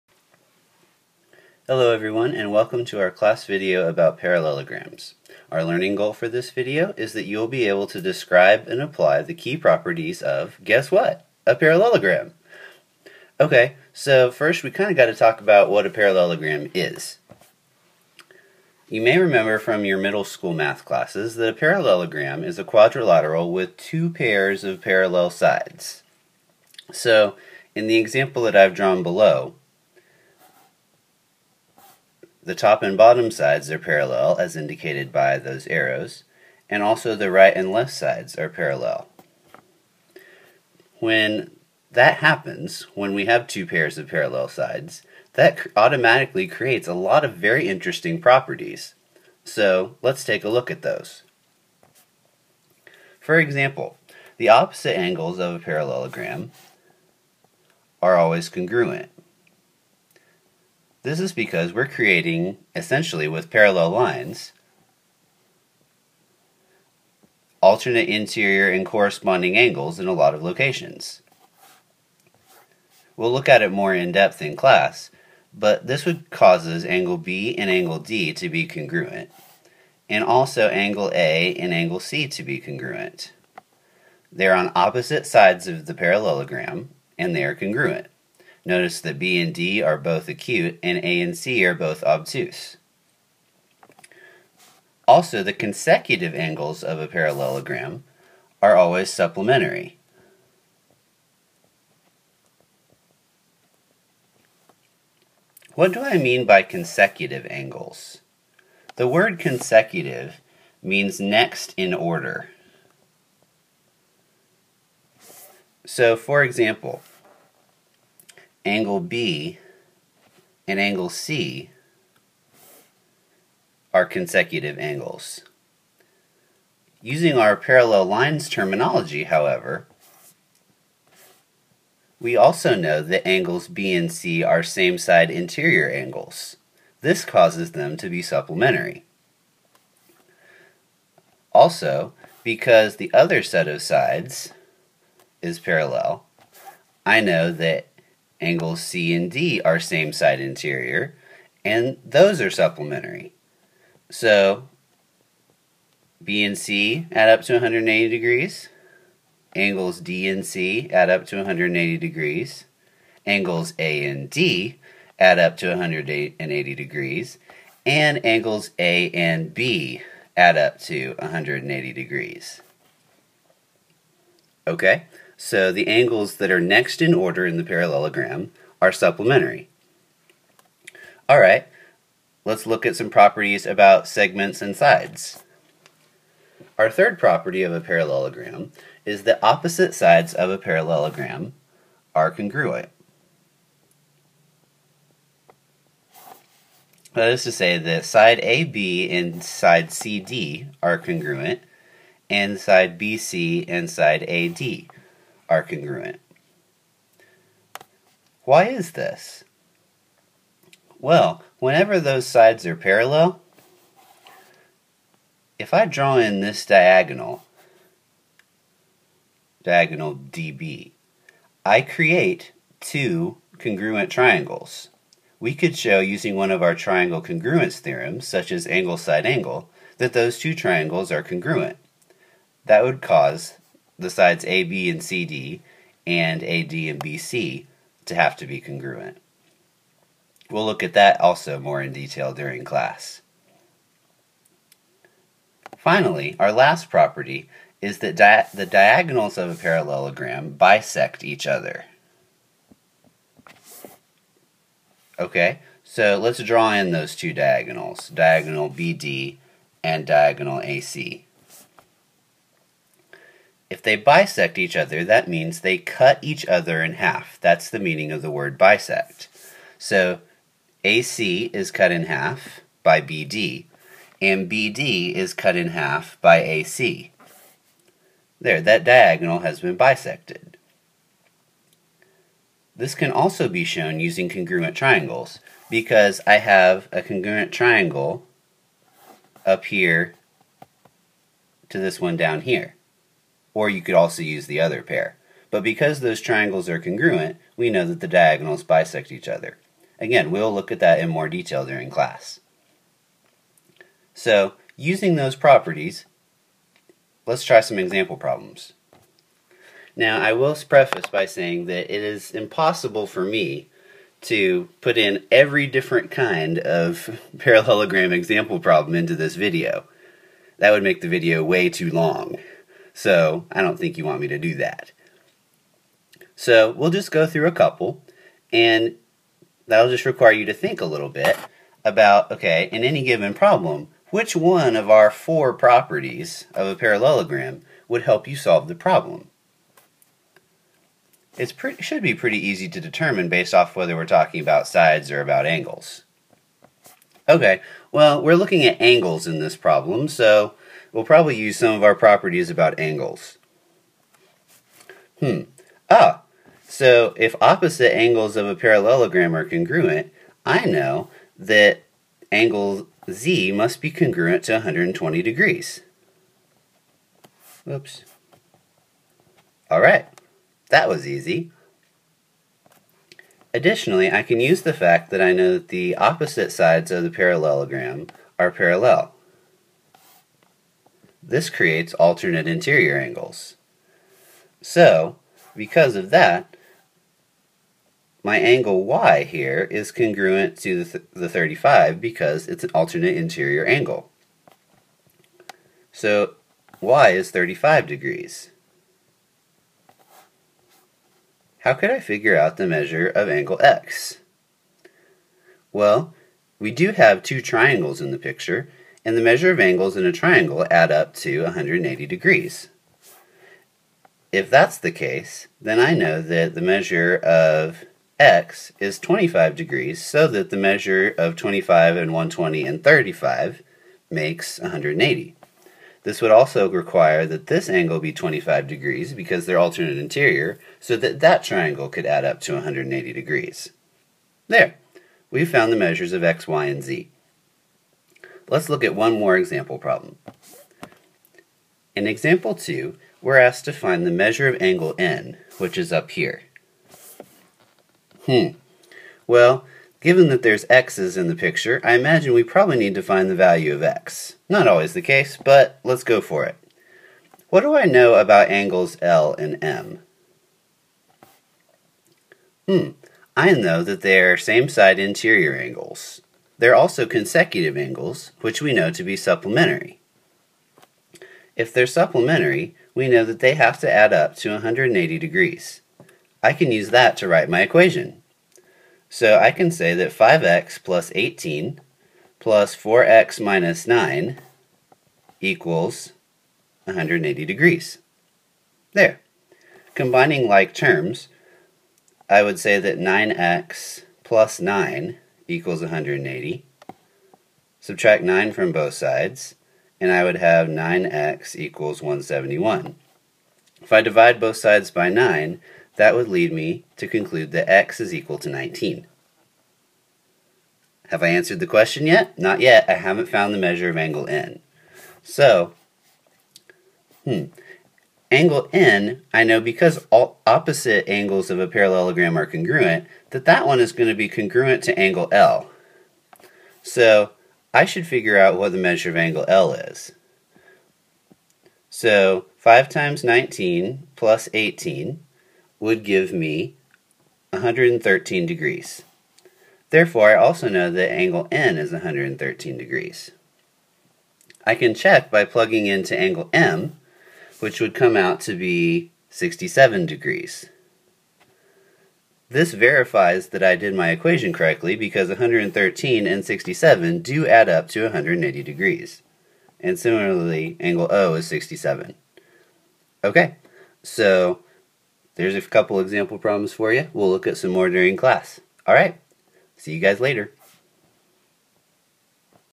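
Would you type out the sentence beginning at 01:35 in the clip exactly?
Also, the consecutive angles of a parallelogram are always supplementary.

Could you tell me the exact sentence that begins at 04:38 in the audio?
There, that diagonal has been bisected.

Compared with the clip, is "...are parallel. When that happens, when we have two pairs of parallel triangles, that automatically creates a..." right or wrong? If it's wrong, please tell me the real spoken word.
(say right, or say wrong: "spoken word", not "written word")
wrong: "sides", not "triangles".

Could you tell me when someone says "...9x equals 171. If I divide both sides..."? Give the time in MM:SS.
08:20.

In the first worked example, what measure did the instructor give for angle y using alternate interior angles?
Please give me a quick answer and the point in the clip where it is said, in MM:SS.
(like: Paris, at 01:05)
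35 degrees, at 06:36.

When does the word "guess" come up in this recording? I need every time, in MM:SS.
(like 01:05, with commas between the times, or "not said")
00:10.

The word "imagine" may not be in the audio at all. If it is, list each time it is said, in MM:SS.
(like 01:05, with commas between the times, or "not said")
07:31.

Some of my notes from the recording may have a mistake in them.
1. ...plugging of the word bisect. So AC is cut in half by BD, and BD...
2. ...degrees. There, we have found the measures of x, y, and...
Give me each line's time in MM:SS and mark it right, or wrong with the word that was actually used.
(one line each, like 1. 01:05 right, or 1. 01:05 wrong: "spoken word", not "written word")
1. 04:27 wrong: "meaning", not "plugging"
2. 07:13 right.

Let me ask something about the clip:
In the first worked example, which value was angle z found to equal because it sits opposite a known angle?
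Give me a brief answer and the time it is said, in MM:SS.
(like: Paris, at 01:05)
120 degrees, at 06:04.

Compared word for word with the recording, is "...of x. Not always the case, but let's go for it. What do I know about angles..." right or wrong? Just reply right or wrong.
right.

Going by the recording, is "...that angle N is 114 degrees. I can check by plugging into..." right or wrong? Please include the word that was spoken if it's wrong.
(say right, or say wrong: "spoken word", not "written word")
wrong: "113", not "114".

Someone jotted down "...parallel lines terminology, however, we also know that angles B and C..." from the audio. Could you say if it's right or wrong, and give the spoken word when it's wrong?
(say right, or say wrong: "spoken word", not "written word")
right.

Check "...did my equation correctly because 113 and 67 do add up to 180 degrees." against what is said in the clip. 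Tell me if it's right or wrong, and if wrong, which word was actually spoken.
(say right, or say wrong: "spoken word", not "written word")
right.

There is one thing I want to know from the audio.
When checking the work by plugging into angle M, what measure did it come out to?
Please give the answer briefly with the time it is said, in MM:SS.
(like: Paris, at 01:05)
67 degrees, at 09:09.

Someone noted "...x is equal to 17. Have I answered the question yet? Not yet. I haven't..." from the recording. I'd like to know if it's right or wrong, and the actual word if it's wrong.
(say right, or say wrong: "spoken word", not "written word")
wrong: "19", not "17".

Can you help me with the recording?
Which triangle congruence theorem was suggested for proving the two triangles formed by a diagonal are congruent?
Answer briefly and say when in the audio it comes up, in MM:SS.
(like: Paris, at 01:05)
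Angle side angle, at 03:48.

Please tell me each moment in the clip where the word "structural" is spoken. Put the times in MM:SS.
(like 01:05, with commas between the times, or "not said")
not said.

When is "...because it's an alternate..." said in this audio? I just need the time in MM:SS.
06:32.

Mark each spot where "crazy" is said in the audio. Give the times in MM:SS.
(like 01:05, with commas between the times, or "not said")
not said.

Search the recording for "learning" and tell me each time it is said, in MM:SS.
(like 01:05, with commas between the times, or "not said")
00:05.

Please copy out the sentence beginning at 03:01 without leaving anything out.
All right, let's look at some properties about segments and sides.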